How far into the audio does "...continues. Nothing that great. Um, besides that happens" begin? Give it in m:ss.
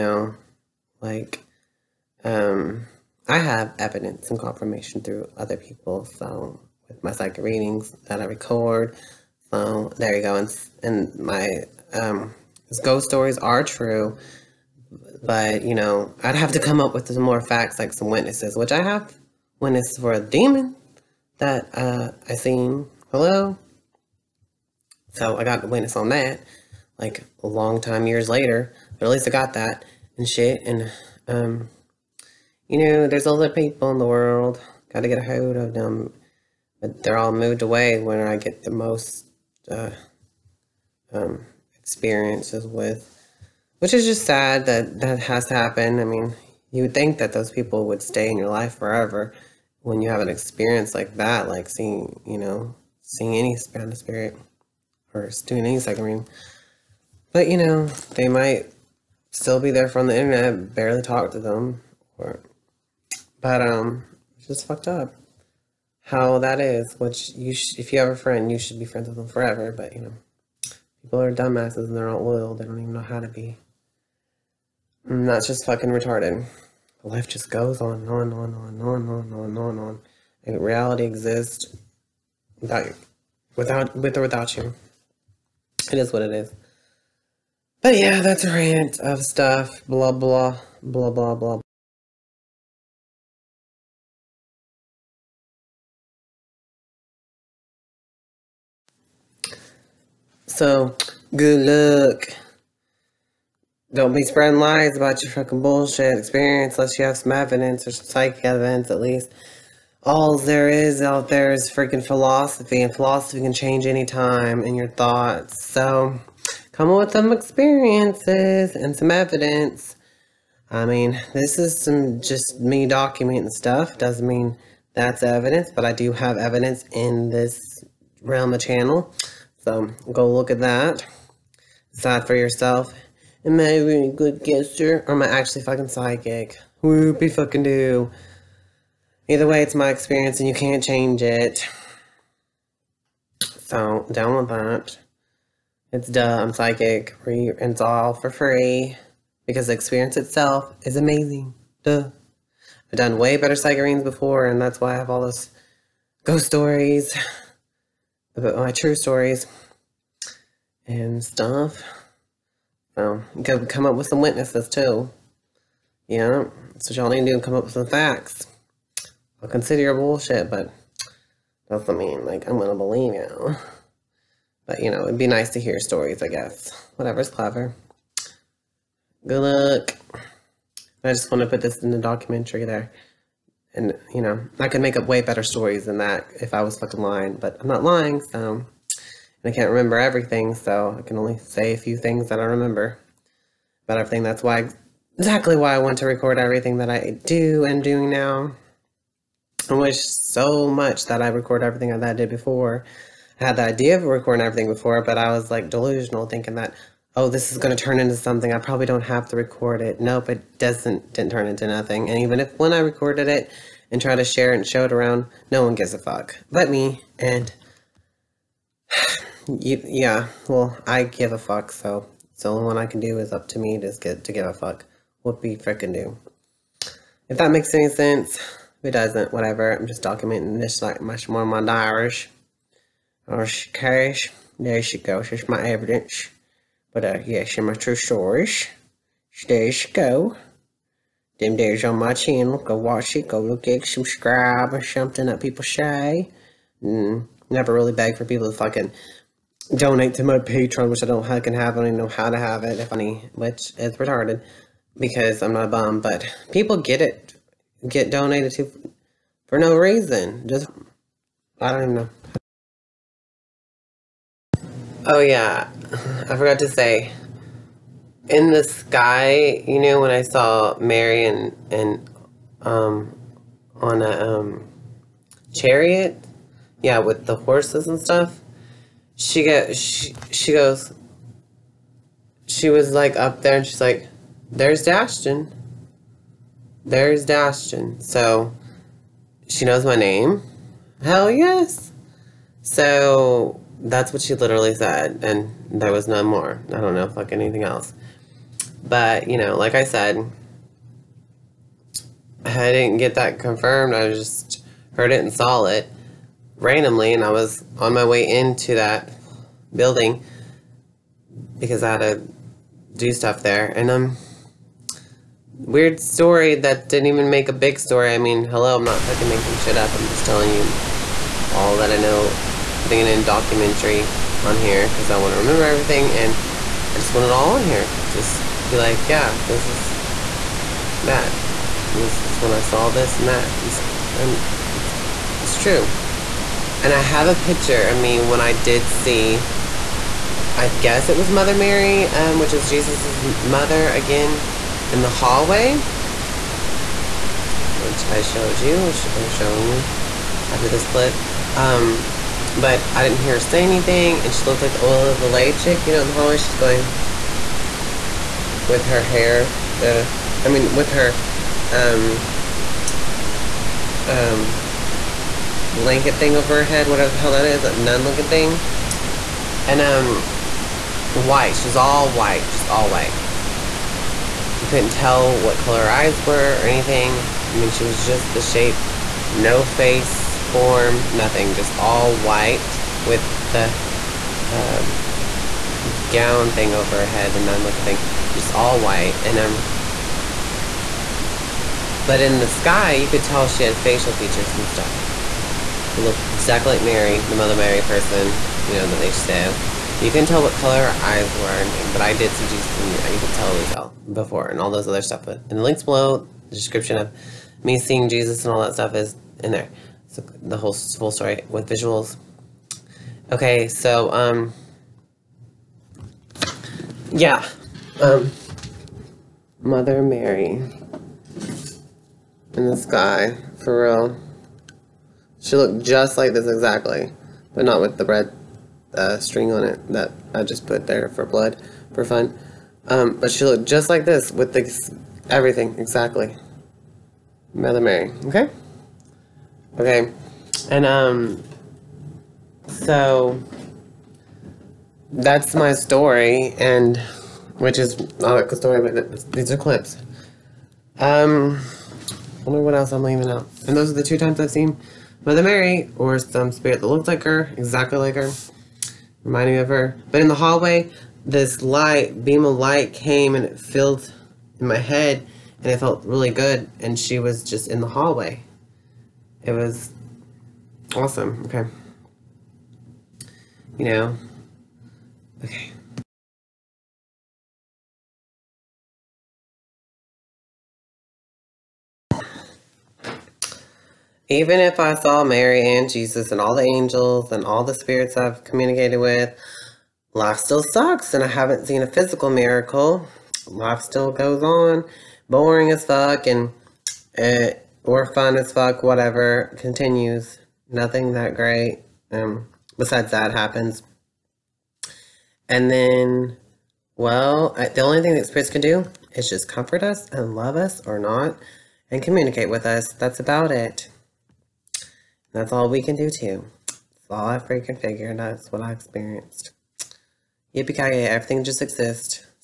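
8:19.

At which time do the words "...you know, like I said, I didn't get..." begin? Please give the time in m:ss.
4:59.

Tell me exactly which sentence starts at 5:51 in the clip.
Um, but I didn't hear her say anything, and she looked like the Ola Valet chick, you know, in the hallway.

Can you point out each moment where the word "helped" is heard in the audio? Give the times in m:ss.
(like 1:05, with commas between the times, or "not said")
not said.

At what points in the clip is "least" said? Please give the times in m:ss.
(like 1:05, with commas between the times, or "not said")
0:29, 1:48.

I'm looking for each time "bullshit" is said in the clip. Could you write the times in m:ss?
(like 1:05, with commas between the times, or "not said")
1:45, 2:49.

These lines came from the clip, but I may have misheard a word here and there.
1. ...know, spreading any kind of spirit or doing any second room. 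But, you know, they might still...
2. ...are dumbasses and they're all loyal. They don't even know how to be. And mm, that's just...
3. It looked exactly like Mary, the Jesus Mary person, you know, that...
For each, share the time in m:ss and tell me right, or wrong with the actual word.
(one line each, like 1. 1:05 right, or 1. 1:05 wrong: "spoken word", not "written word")
1. 0:52 wrong: "seeing", not "spreading"
2. 1:11 right
3. 6:35 wrong: "Mother", not "Jesus".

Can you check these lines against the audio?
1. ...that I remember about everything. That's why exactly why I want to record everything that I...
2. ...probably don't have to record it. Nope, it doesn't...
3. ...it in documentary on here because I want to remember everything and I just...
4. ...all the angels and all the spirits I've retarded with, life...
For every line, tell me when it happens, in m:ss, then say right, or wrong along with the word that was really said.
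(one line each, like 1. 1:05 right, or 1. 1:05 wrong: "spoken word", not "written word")
1. 3:12 right
2. 3:28 right
3. 5:22 right
4. 8:06 wrong: "communicated", not "retarded".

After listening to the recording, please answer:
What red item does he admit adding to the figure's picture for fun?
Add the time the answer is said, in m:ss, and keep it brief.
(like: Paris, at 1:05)
string, at 7:09.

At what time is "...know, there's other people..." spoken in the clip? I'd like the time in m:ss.
0:32.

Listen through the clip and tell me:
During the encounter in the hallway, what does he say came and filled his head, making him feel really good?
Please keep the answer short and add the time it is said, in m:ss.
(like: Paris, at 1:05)
beam of light, at 7:42.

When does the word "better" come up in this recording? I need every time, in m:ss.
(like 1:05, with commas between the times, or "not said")
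2:33, 3:05.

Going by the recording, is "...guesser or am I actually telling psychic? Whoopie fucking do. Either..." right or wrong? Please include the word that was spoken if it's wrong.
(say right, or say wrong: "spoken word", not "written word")
wrong: "fucking", not "telling".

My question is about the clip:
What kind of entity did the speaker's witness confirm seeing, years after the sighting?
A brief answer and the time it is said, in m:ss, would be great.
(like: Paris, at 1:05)
demon, at 0:20.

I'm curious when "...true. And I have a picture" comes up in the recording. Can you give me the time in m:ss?
5:35.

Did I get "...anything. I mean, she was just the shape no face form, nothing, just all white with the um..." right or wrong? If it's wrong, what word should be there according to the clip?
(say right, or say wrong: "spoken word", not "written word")
right.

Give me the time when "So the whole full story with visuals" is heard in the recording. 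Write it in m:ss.
6:50.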